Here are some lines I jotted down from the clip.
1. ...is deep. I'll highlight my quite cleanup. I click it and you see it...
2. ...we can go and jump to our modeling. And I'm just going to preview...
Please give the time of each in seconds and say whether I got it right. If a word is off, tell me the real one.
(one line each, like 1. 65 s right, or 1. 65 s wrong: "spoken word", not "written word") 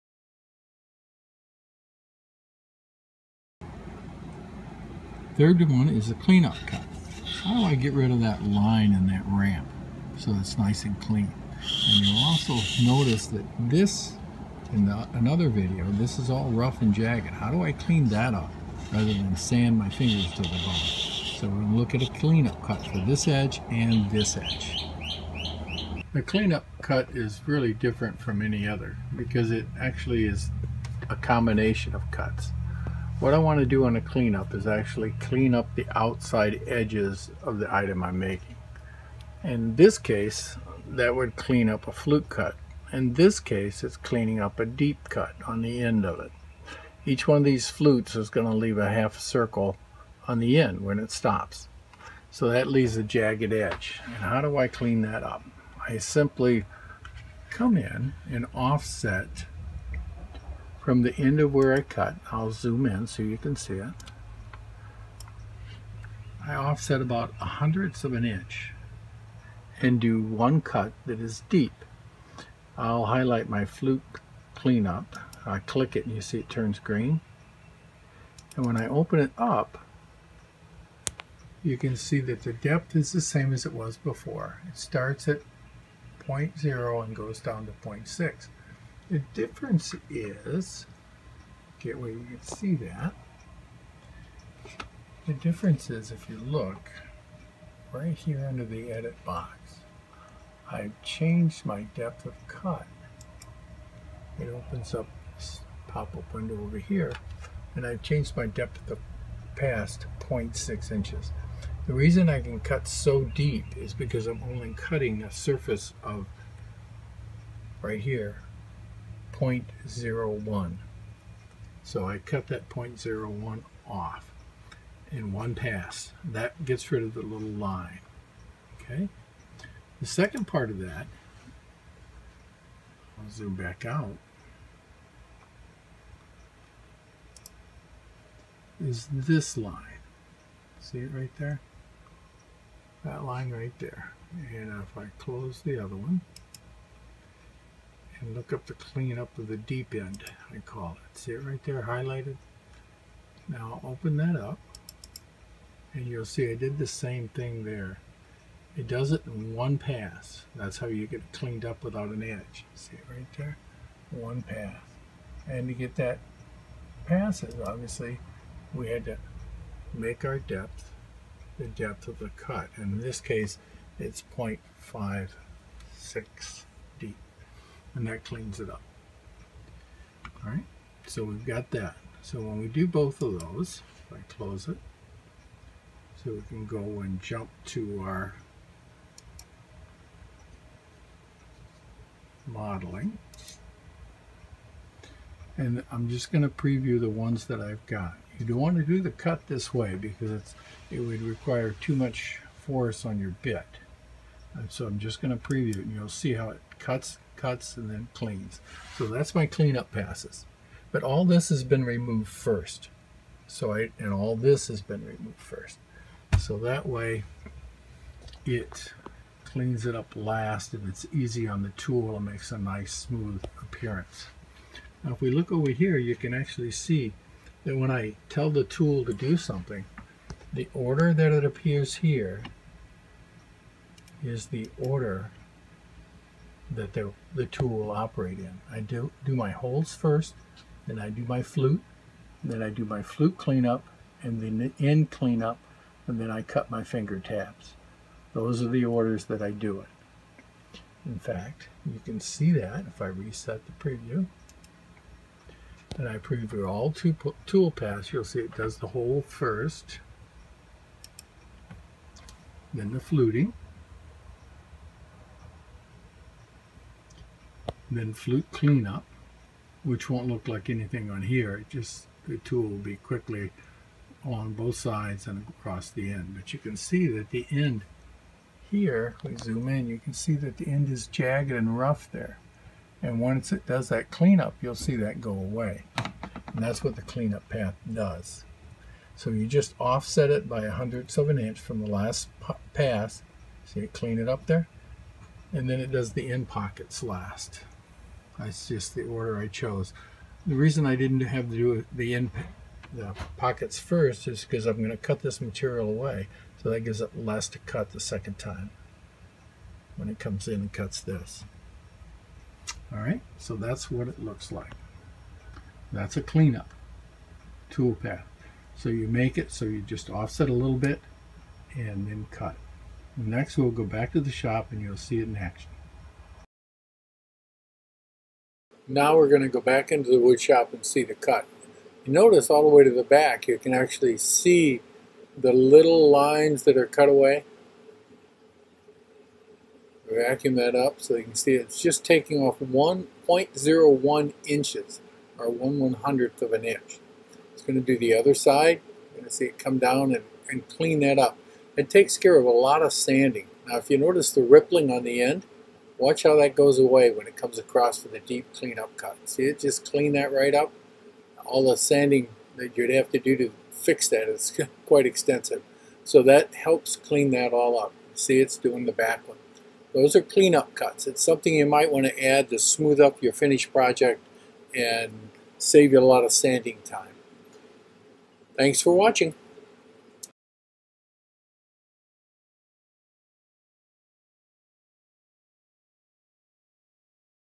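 1. 71 s wrong: "flute", not "quite"
2. 186 s right.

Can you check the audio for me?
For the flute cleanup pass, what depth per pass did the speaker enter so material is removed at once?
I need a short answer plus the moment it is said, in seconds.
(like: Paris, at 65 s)
0.6 inches, at 110 s.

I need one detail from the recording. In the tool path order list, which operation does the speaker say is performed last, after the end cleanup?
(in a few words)
finger tabs.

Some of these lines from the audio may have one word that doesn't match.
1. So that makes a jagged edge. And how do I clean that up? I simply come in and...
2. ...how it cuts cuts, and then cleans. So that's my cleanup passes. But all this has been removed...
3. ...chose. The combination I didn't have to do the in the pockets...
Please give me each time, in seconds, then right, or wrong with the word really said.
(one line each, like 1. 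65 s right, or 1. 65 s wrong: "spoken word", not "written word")
1. 52 s wrong: "leaves", not "makes"
2. 206 s right
3. 299 s wrong: "reason", not "combination".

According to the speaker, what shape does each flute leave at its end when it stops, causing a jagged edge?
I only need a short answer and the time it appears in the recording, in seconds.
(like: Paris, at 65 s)
half circle, at 48 s.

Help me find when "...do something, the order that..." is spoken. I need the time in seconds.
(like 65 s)
229 s.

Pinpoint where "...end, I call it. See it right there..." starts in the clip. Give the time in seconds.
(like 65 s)
149 s.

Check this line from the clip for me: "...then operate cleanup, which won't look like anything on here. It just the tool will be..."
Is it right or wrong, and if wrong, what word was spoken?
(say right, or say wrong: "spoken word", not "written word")
wrong: "flute", not "operate".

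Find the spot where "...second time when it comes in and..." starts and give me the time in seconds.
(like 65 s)
307 s.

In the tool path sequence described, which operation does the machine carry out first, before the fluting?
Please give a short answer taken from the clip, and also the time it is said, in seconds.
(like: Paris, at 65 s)
holes, at 239 s.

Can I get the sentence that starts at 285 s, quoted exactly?
And that's what the cleanup path does.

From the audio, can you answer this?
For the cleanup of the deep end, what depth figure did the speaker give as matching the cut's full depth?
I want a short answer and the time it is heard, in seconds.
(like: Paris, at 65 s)
0.56, at 174 s.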